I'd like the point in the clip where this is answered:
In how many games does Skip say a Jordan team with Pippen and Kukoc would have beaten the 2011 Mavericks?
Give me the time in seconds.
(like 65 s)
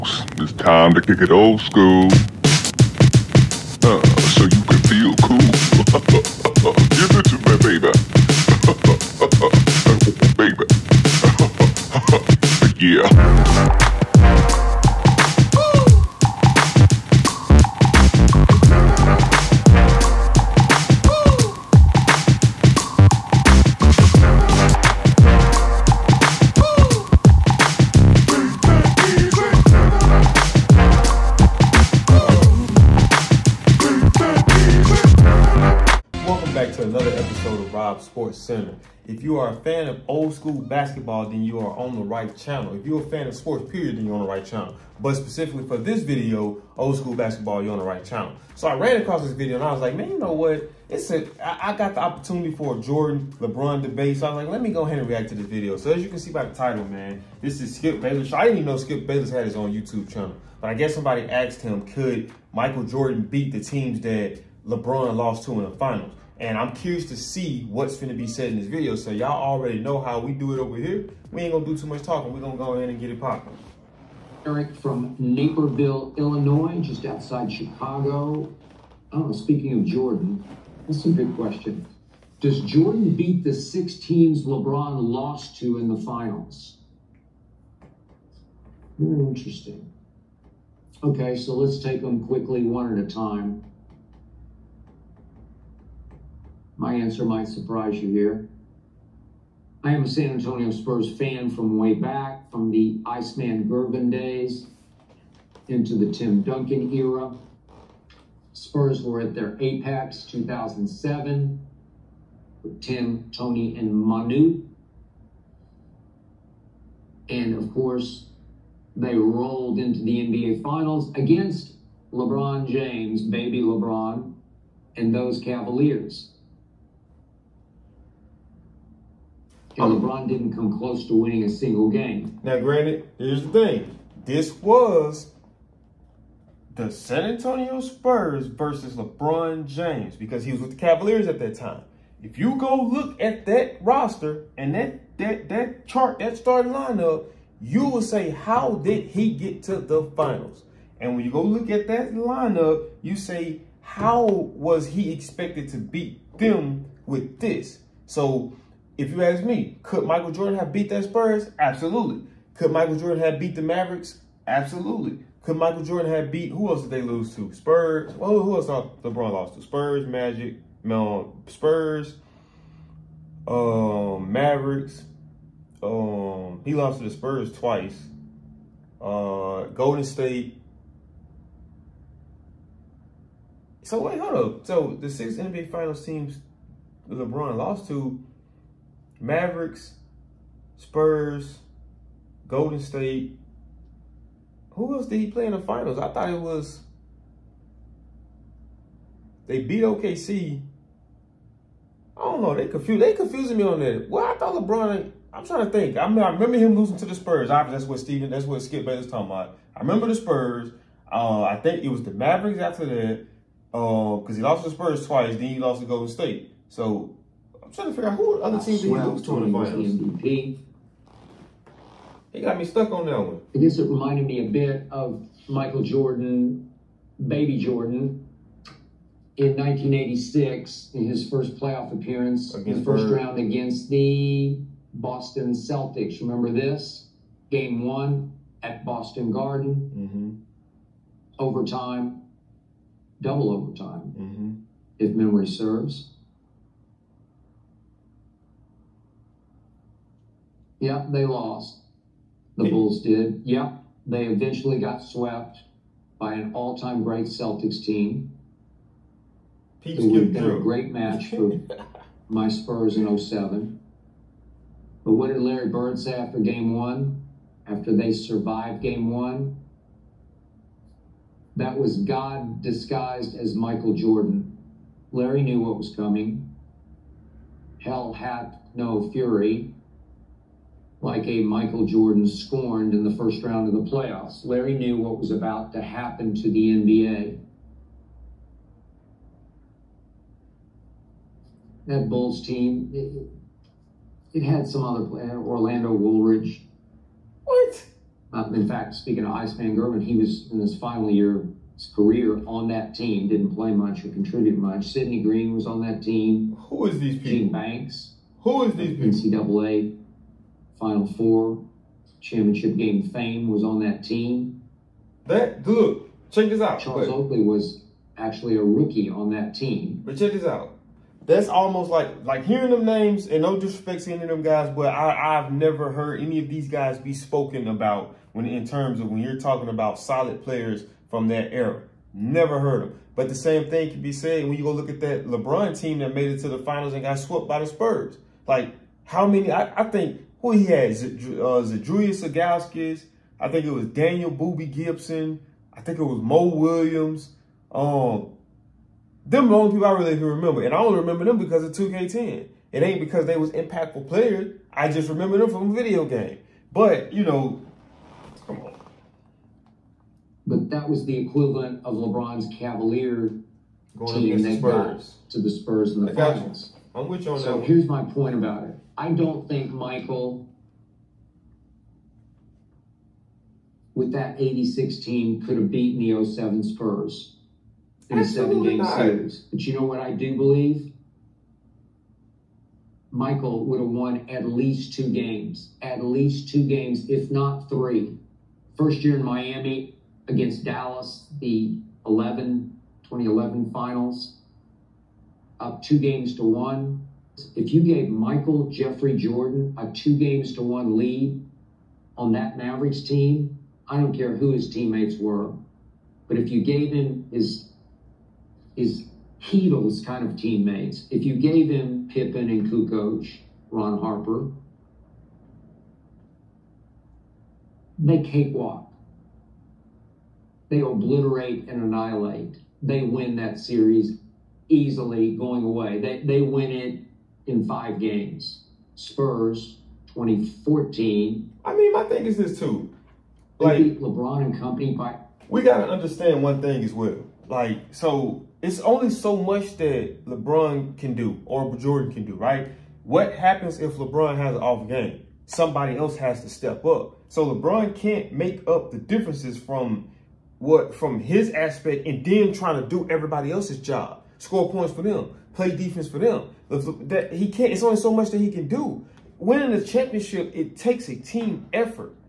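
427 s.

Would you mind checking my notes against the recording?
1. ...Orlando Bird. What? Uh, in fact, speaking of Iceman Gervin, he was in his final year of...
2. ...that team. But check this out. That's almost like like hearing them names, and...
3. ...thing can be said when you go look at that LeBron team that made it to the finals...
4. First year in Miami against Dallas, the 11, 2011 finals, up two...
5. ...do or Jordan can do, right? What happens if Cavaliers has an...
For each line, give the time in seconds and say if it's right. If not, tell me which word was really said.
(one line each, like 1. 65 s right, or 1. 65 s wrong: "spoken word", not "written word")
1. 295 s wrong: "Woolridge", not "Bird"
2. 319 s right
3. 333 s right
4. 388 s right
5. 441 s wrong: "LeBron", not "Cavaliers".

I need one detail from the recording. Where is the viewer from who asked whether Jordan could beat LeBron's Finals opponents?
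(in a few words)
Naperville, Illinois.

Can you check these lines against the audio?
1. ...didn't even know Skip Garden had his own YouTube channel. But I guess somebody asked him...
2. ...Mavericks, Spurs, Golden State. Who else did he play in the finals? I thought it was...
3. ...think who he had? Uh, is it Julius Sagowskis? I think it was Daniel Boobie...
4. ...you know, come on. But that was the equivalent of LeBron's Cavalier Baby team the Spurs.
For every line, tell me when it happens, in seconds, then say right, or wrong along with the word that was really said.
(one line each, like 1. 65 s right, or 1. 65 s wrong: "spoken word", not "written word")
1. 58 s wrong: "Bayless", not "Garden"
2. 189 s right
3. 339 s right
4. 357 s wrong: "Going", not "Baby".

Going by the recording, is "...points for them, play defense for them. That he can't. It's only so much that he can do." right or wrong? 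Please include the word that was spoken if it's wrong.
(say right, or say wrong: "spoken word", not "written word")
right.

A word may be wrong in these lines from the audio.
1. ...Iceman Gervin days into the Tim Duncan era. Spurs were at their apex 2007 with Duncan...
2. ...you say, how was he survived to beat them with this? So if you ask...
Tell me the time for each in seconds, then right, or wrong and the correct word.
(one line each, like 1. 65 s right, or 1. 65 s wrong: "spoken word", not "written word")
1. 103 s wrong: "Tim", not "Duncan"
2. 153 s wrong: "expected", not "survived".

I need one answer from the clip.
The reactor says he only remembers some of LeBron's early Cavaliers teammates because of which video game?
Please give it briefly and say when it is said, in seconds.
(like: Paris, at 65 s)
2K10, at 351 s.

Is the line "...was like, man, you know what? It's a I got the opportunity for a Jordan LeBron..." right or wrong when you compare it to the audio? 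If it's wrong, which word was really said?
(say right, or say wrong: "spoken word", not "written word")
right.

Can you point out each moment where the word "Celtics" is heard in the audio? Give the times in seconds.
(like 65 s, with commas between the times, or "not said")
235 s, 257 s.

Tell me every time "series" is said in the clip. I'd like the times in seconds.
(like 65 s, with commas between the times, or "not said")
378 s, 423 s.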